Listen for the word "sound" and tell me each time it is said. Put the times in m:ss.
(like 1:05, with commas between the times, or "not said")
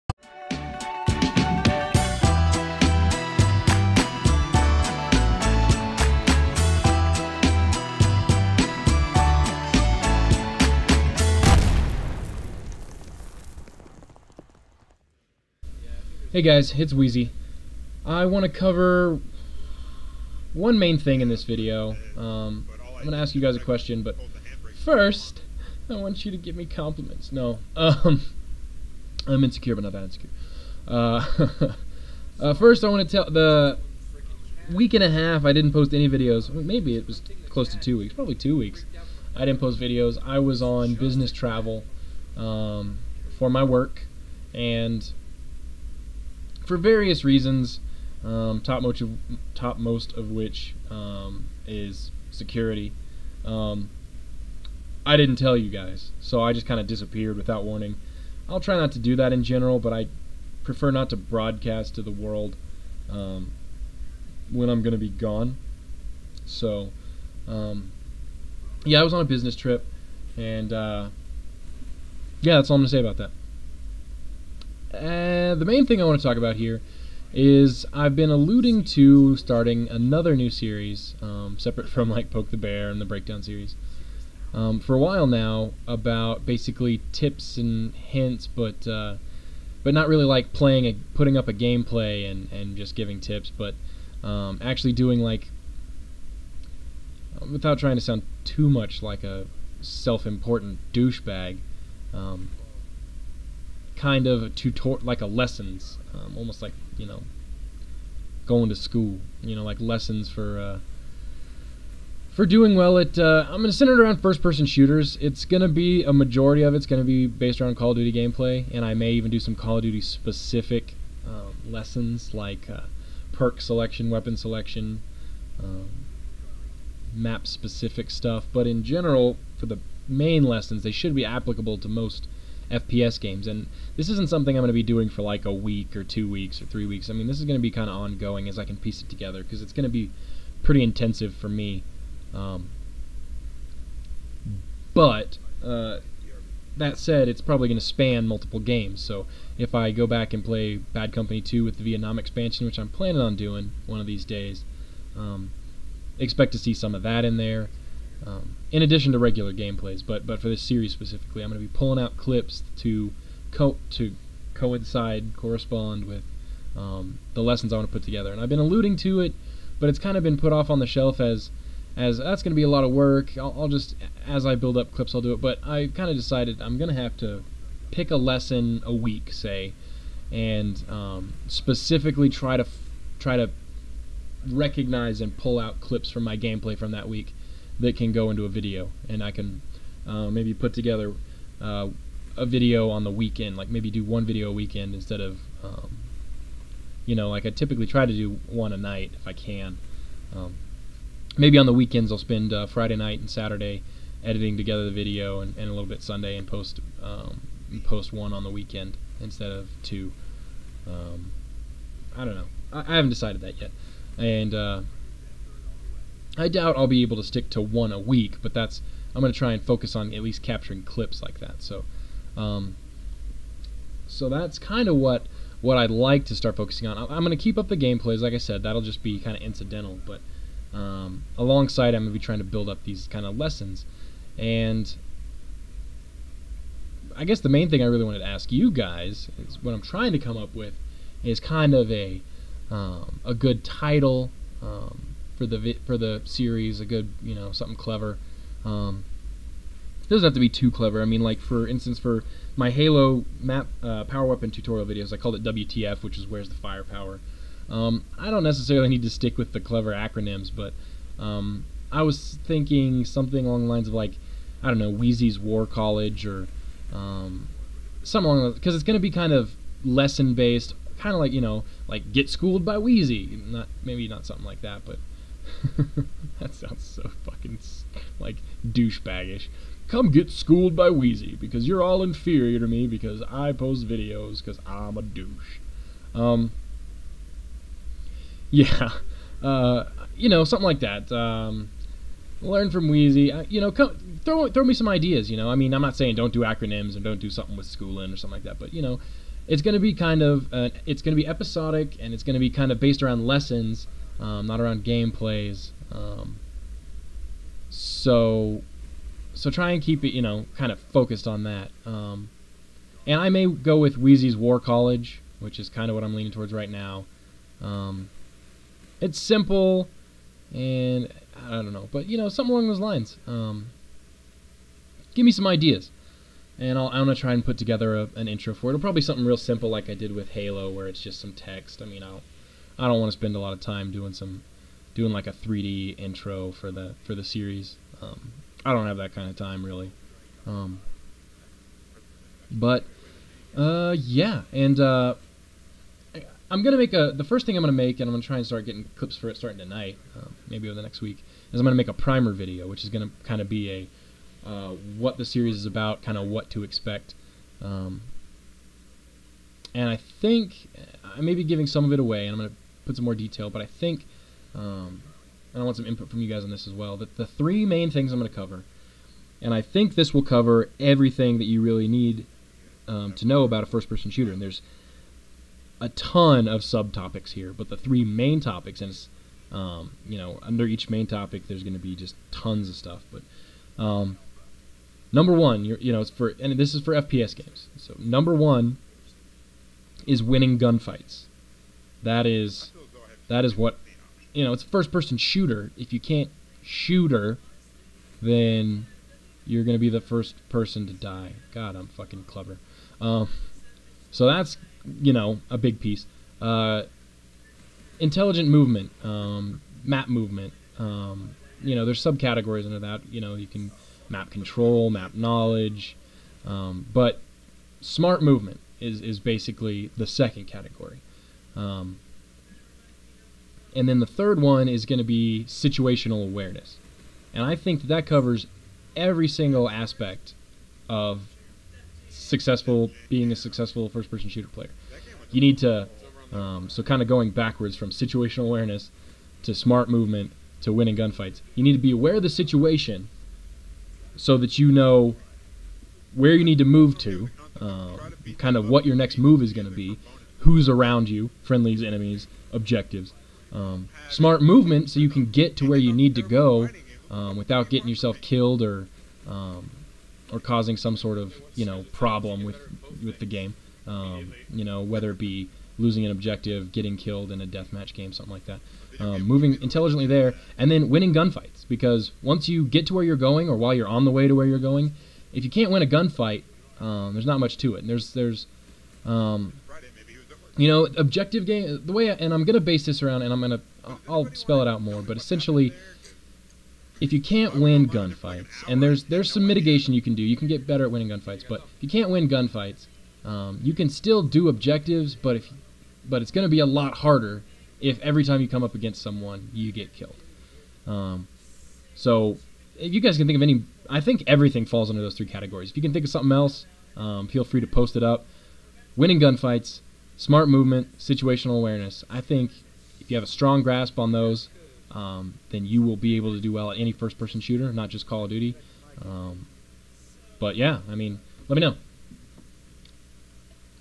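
1:38, 4:36.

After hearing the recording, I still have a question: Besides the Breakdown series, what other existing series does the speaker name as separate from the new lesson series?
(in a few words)
Poke the Bear.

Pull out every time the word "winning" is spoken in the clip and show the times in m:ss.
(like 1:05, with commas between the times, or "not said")
6:30, 7:20, 7:50, 8:10, 8:28.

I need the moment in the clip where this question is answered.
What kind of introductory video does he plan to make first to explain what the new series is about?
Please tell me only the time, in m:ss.
5:51.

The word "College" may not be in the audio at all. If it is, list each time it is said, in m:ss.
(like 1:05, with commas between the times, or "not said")
4:25, 5:14.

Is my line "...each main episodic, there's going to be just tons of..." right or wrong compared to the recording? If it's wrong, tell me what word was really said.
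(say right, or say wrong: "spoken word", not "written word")
wrong: "topic", not "episodic".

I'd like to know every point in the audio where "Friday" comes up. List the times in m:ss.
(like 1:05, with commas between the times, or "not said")
3:22.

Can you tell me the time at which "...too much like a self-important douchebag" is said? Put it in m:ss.
1:38.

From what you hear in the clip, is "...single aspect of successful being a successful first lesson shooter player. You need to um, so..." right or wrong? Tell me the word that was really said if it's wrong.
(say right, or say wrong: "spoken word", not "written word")
wrong: "person", not "lesson".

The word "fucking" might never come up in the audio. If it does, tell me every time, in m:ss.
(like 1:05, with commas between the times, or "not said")
4:37, 6:41.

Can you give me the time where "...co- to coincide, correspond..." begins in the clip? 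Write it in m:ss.
2:43.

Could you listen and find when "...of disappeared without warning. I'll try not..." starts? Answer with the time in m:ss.
0:56.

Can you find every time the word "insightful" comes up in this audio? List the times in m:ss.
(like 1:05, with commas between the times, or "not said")
not said.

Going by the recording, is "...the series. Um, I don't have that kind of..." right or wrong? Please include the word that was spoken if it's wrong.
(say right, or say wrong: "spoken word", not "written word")
right.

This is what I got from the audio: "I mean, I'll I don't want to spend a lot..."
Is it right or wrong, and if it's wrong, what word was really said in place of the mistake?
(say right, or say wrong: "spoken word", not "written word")
right.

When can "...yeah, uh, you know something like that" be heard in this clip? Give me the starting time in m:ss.
4:48.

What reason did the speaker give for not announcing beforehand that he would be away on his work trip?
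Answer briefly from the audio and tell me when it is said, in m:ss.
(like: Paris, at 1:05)
Security, at 0:52.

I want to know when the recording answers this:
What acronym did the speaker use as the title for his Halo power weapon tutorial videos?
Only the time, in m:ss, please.
4:15.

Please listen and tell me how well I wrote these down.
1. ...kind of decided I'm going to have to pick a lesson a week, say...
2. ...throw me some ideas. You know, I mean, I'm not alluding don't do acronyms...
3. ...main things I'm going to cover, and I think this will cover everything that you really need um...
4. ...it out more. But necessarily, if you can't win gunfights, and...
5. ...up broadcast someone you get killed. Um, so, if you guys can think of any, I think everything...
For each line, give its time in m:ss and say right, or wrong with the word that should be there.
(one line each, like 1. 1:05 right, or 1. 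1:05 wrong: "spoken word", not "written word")
1. 2:55 right
2. 4:54 wrong: "saying", not "alluding"
3. 6:07 right
4. 8:04 wrong: "essentially", not "necessarily"
5. 8:18 wrong: "against", not "broadcast".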